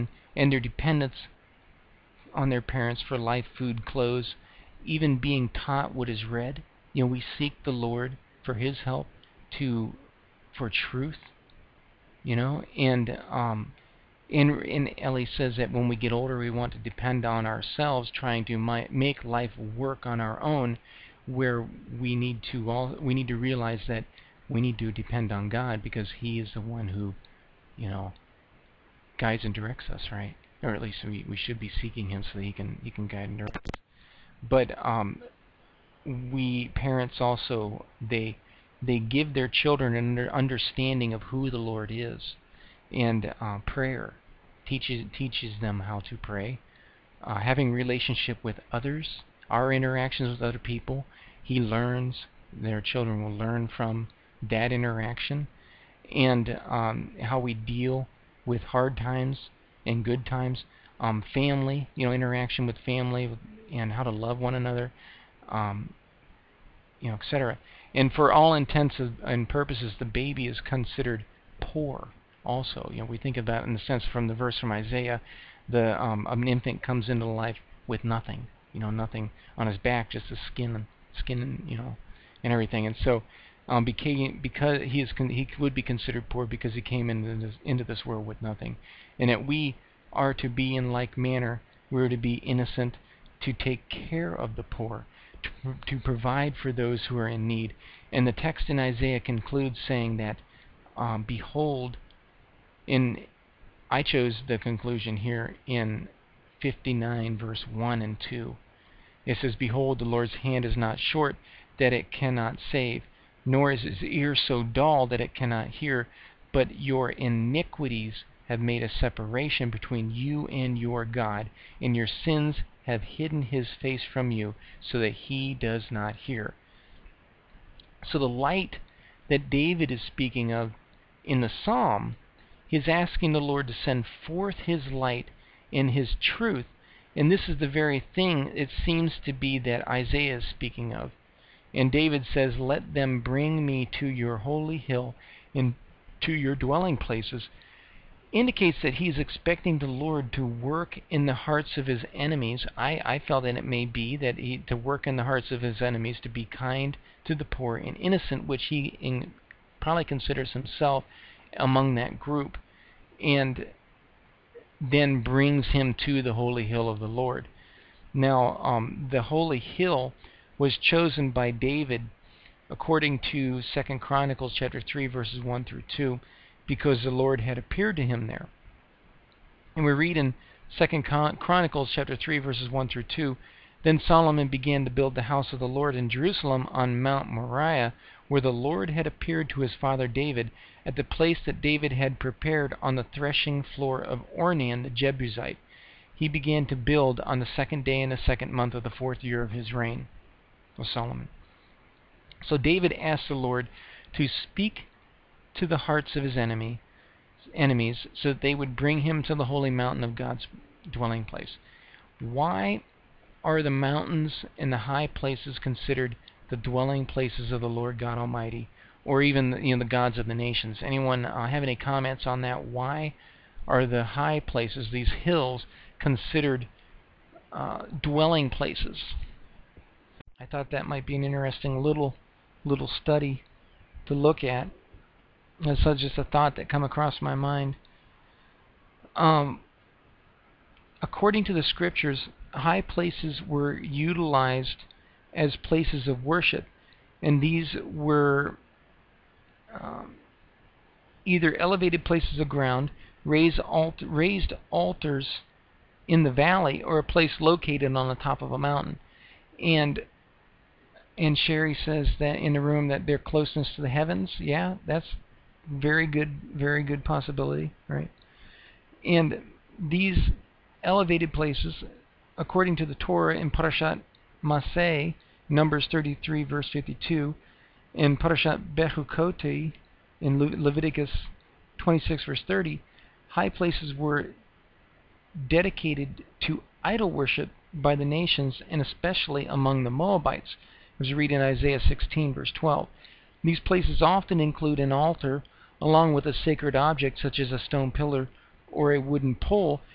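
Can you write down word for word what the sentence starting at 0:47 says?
Uh, having relationship with others, our interactions with other people, he learns.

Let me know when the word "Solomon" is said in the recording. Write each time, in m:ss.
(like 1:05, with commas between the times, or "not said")
3:04, 3:20.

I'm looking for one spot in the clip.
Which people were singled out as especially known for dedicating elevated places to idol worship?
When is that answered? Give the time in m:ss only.
4:49.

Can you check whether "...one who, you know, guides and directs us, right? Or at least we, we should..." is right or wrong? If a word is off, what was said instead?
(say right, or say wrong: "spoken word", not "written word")
right.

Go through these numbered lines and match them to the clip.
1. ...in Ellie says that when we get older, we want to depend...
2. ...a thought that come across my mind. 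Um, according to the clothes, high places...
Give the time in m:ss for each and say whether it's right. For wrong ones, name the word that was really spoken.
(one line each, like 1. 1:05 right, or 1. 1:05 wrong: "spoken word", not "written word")
1. 0:14 right
2. 3:56 wrong: "scriptures", not "clothes".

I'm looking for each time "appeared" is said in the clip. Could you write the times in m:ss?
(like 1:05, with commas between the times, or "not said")
2:57, 3:09.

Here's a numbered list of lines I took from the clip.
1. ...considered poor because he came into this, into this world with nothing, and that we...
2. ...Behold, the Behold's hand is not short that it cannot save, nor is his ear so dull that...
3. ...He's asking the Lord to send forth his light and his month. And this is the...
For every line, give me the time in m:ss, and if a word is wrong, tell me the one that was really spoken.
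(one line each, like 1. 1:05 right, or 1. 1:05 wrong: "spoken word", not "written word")
1. 1:25 right
2. 1:49 wrong: "Lord", not "Behold"
3. 2:12 wrong: "truth", not "month".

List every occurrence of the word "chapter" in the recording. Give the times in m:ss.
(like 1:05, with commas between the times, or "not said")
2:54, 3:01.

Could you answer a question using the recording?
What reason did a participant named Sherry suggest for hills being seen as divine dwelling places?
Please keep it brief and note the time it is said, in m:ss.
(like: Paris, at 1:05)
Closeness to the heavens, at 4:23.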